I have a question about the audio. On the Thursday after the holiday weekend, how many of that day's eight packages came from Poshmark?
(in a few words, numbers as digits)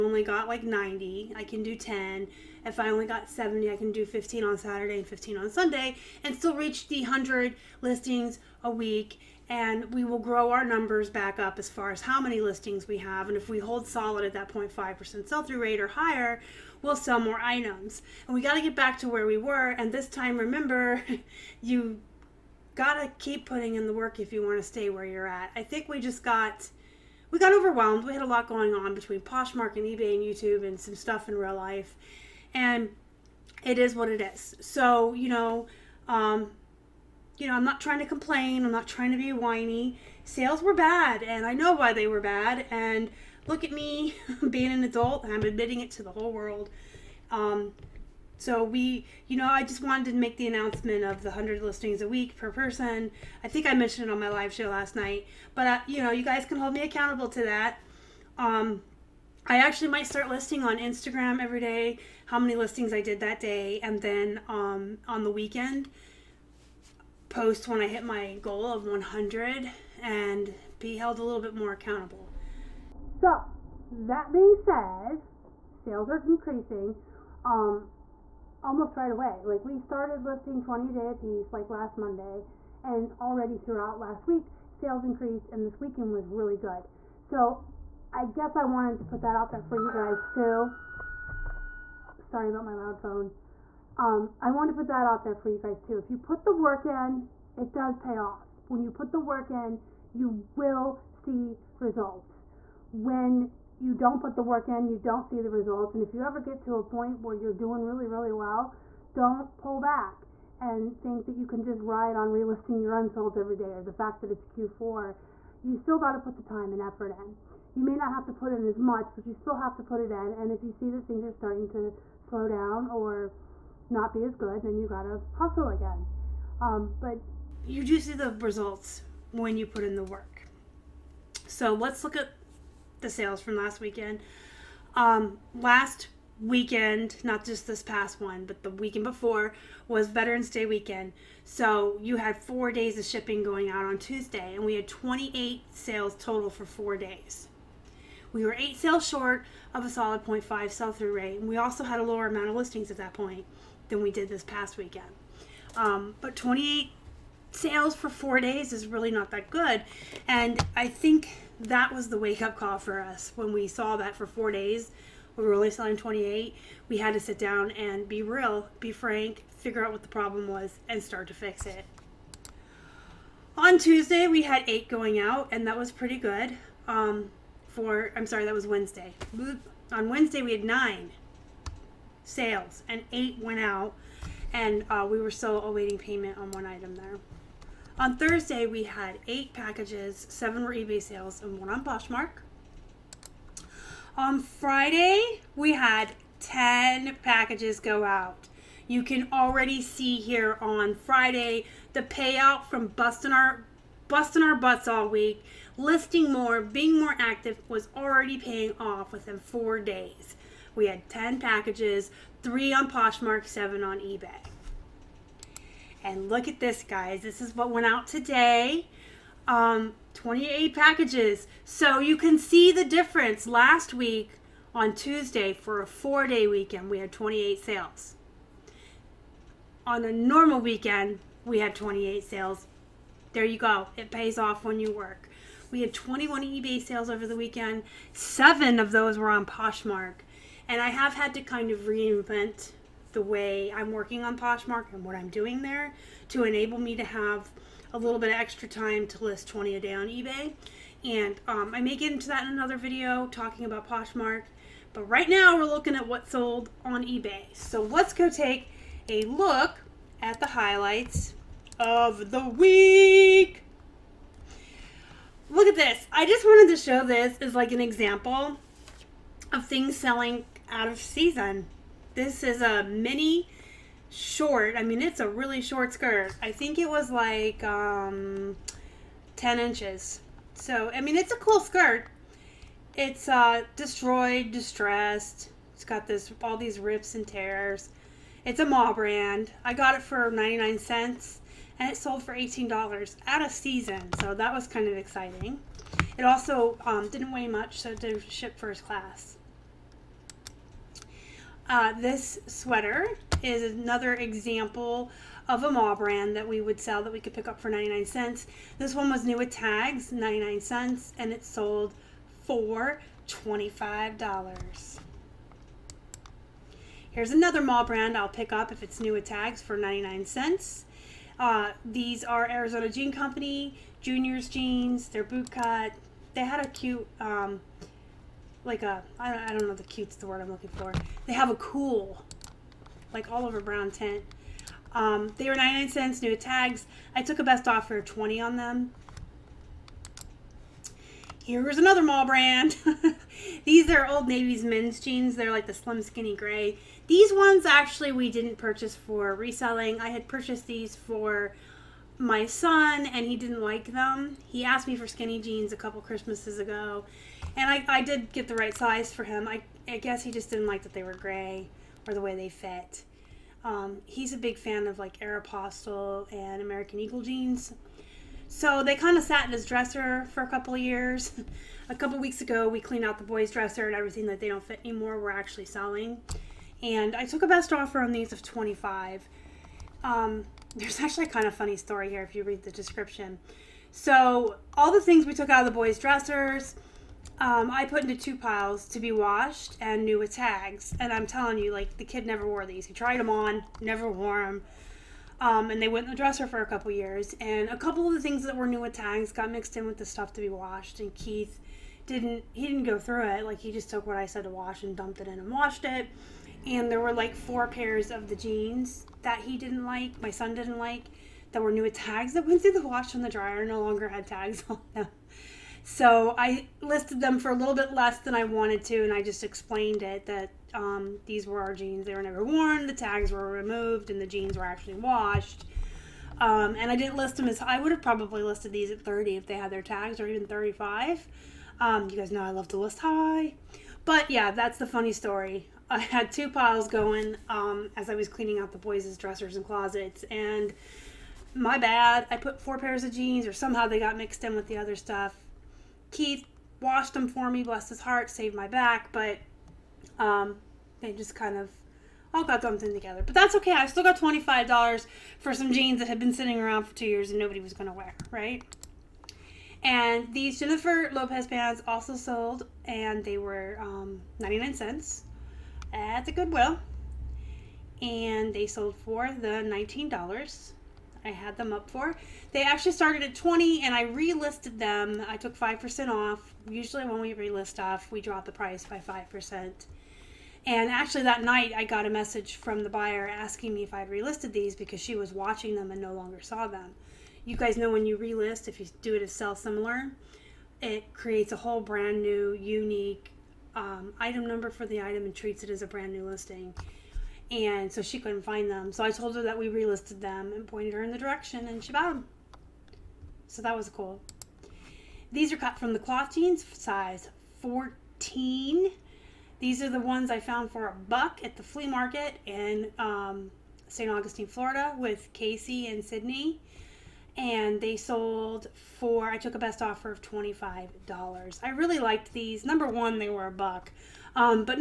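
1.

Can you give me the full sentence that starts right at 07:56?
Usually when we relist off, we drop the price by 5%.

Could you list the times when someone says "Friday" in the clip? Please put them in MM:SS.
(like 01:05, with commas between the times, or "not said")
03:14, 03:20.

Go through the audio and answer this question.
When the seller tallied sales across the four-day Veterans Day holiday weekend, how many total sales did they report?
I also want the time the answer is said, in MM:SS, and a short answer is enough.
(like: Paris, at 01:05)
28, at 02:24.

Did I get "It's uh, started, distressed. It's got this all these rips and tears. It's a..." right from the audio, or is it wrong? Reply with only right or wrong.
wrong.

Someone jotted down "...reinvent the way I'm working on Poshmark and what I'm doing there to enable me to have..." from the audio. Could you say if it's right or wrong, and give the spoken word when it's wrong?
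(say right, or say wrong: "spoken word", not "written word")
right.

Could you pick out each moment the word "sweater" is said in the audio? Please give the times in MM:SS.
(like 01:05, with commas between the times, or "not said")
05:02.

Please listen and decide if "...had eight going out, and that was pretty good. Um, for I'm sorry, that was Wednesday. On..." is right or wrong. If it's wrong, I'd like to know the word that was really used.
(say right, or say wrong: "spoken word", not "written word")
right.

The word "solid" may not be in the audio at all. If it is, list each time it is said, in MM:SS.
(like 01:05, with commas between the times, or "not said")
00:13, 02:29.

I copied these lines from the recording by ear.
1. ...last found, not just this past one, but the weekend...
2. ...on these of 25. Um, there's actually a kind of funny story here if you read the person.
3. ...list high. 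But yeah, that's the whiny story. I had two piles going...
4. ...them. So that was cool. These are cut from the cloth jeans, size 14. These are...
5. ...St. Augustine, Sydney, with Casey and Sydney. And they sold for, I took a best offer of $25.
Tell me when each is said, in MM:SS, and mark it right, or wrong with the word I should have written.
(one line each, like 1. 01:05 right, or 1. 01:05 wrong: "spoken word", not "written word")
1. 02:15 wrong: "weekend", not "found"
2. 06:18 wrong: "description", not "person"
3. 07:12 wrong: "funny", not "whiny"
4. 08:22 right
5. 08:33 wrong: "Florida", not "Sydney".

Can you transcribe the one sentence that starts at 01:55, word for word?
You still got to put the time and effort in.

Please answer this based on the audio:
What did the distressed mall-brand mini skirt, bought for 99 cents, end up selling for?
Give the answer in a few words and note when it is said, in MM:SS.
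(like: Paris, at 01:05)
$18, at 04:52.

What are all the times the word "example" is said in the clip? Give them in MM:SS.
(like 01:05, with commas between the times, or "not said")
04:27, 05:04.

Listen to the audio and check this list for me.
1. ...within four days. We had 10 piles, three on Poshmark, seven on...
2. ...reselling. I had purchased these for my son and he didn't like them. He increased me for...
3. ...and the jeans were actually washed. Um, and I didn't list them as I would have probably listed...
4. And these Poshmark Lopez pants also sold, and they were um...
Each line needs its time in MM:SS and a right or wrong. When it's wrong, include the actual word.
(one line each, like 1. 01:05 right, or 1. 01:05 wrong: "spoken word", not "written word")
1. 03:29 wrong: "packages", not "piles"
2. 05:49 wrong: "asked", not "increased"
3. 07:04 right
4. 07:39 wrong: "Jennifer", not "Poshmark".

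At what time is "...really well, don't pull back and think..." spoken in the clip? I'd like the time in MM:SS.
01:48.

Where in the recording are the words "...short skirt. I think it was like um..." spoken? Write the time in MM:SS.
04:35.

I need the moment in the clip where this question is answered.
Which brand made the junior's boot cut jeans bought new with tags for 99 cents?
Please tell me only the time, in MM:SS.
05:22.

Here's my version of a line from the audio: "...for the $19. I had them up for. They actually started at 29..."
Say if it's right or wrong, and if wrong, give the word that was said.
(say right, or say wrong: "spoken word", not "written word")
wrong: "20", not "29".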